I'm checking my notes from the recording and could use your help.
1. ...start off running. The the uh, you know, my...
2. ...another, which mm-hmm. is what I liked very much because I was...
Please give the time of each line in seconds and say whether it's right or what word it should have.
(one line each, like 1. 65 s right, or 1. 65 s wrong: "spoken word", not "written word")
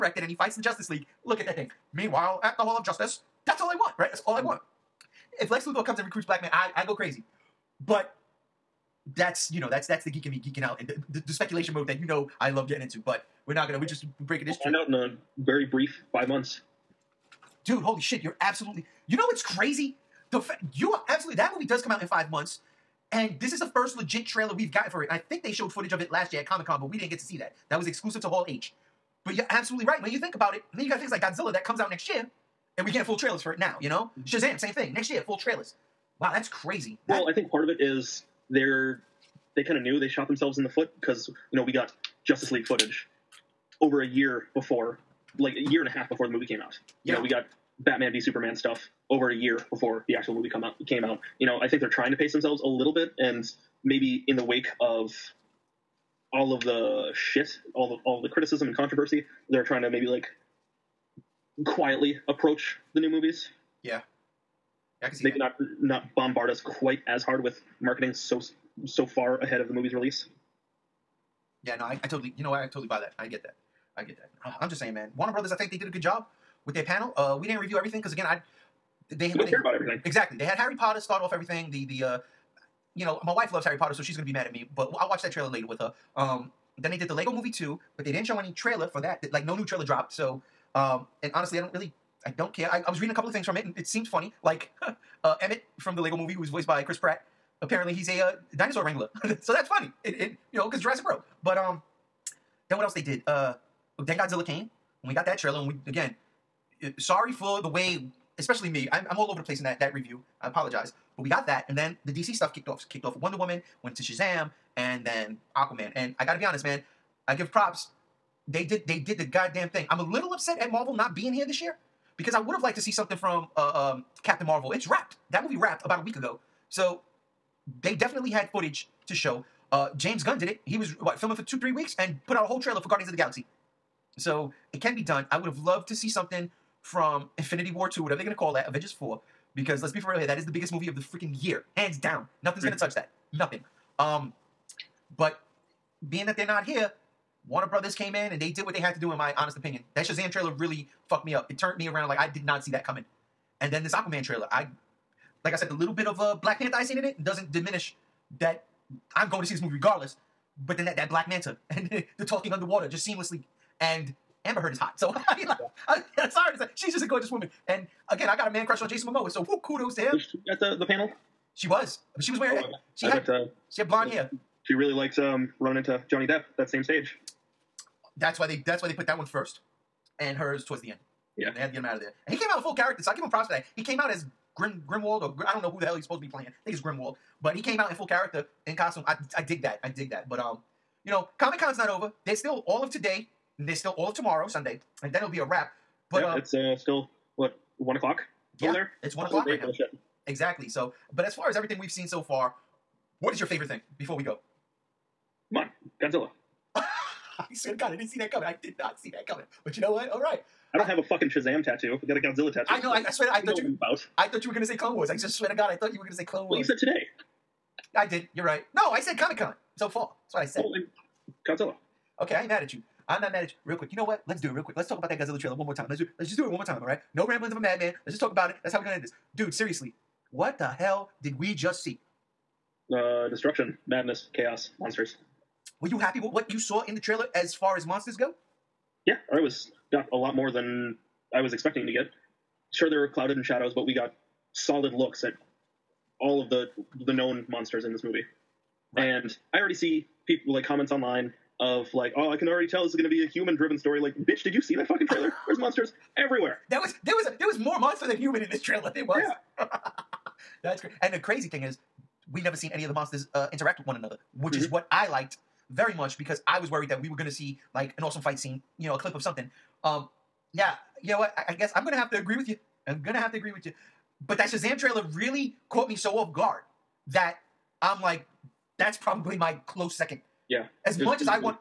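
1. 80 s wrong: "everything", not "running"
2. 263 s right.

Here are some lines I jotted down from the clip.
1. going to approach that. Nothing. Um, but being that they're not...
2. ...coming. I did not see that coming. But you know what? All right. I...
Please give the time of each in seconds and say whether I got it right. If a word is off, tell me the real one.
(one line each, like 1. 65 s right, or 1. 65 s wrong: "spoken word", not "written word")
1. 142 s wrong: "touch", not "approach"
2. 208 s right.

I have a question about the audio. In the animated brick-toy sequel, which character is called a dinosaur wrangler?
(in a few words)
Emmett.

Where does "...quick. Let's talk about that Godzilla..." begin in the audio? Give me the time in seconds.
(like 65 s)
224 s.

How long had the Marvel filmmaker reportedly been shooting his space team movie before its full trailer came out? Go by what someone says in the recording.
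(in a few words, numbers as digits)
2 to 3 weeks.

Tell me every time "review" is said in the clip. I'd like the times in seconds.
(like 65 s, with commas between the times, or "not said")
77 s, 109 s.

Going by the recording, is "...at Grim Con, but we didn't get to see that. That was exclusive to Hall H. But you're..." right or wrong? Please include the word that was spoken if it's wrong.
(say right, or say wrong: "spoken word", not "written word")
wrong: "Comic", not "Grim".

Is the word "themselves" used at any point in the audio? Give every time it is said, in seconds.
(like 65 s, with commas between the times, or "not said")
40 s, 52 s.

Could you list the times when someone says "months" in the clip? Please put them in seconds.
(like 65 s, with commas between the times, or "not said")
16 s, 22 s.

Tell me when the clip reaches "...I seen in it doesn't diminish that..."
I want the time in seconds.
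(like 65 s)
156 s.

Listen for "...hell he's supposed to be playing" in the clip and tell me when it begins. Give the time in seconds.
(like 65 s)
185 s.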